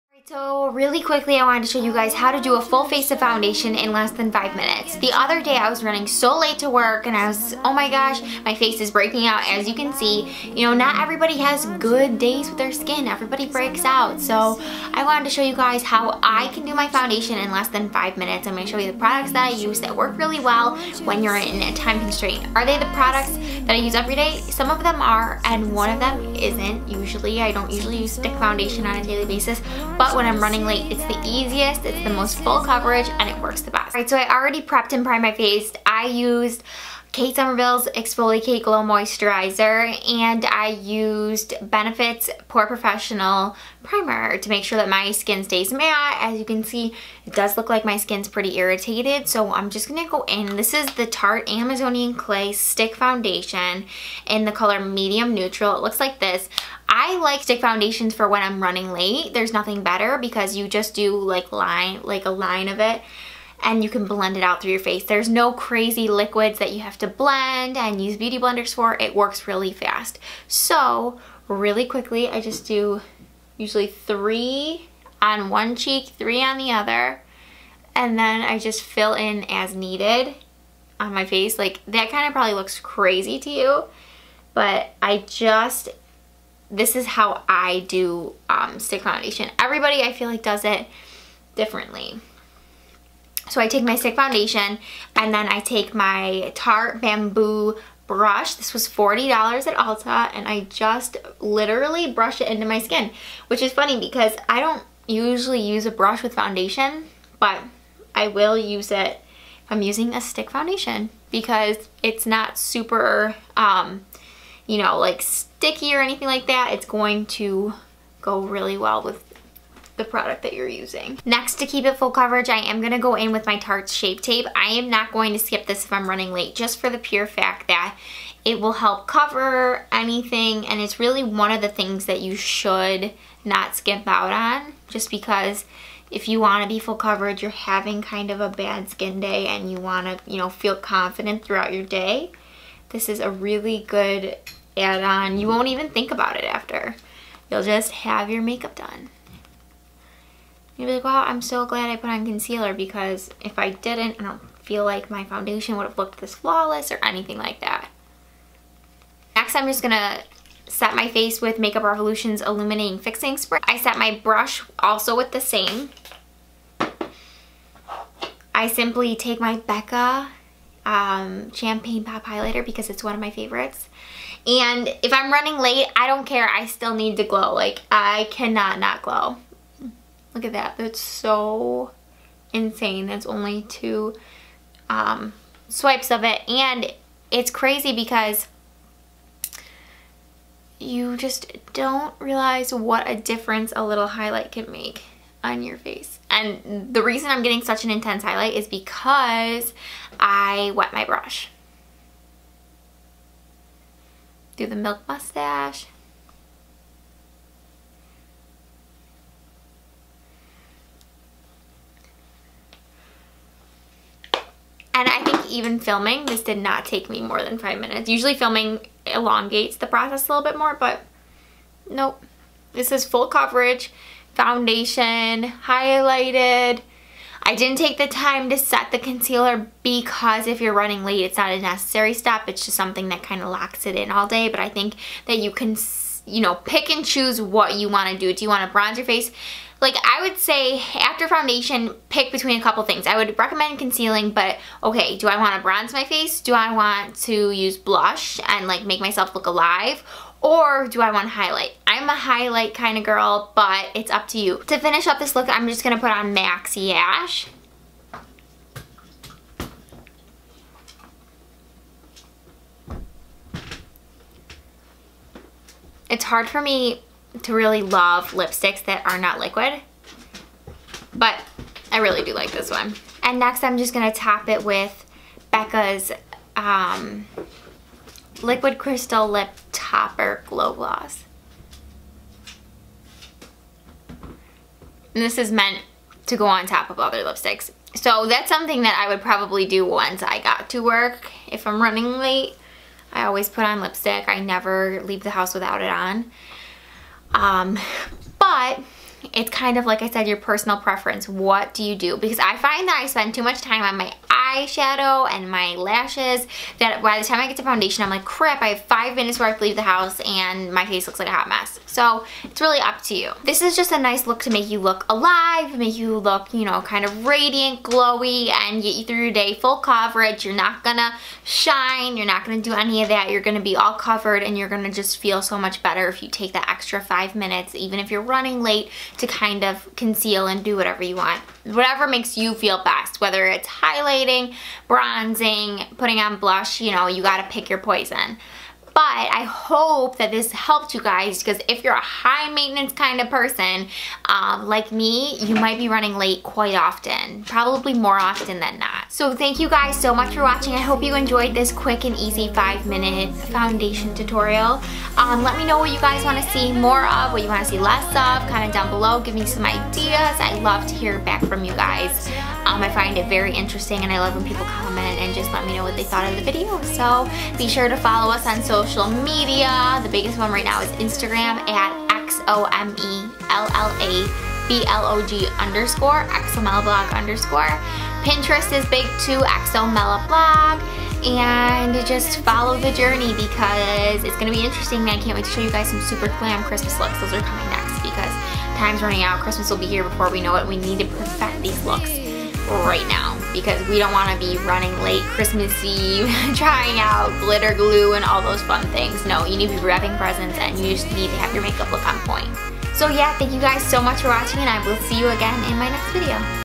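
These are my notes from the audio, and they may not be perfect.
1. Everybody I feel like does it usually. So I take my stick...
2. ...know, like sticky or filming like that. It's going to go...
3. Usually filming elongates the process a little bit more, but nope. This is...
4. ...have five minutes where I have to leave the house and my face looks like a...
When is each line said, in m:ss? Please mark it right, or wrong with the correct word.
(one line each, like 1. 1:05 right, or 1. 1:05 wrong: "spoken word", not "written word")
1. 1:29 wrong: "differently", not "usually"
2. 1:54 wrong: "anything", not "filming"
3. 3:38 right
4. 5:08 right.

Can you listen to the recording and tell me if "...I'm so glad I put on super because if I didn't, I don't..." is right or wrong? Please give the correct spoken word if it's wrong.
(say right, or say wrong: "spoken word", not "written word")
wrong: "concealer", not "super".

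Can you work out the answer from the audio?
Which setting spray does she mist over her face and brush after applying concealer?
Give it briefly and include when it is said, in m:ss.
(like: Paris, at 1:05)
Makeup Revolution's Illuminating Fixing Spray, at 2:41.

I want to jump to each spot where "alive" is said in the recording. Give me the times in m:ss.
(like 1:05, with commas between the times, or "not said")
4:09, 5:15.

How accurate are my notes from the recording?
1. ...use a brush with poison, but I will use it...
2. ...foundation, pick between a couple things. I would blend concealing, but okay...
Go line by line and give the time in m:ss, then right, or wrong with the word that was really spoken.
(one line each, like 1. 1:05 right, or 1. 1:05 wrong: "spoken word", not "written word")
1. 1:45 wrong: "foundation", not "poison"
2. 4:01 wrong: "recommend", not "blend".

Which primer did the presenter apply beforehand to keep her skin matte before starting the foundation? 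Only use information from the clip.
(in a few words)
Benefit's POREfessional Primer.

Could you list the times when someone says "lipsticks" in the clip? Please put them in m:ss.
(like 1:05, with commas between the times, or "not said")
4:28, 4:47, 4:53.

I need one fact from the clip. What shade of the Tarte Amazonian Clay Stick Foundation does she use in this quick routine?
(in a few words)
Medium Neutral.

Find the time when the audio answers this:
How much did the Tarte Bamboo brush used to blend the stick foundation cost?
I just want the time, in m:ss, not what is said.
1:38.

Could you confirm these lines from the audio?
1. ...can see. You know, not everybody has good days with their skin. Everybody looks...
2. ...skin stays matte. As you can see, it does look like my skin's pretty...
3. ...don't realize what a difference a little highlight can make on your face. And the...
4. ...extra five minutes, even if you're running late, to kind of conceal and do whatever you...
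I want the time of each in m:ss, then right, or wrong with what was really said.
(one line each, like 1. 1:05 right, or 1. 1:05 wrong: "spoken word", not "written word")
1. 0:09 wrong: "breaks", not "looks"
2. 0:45 right
3. 3:11 right
4. 5:26 right.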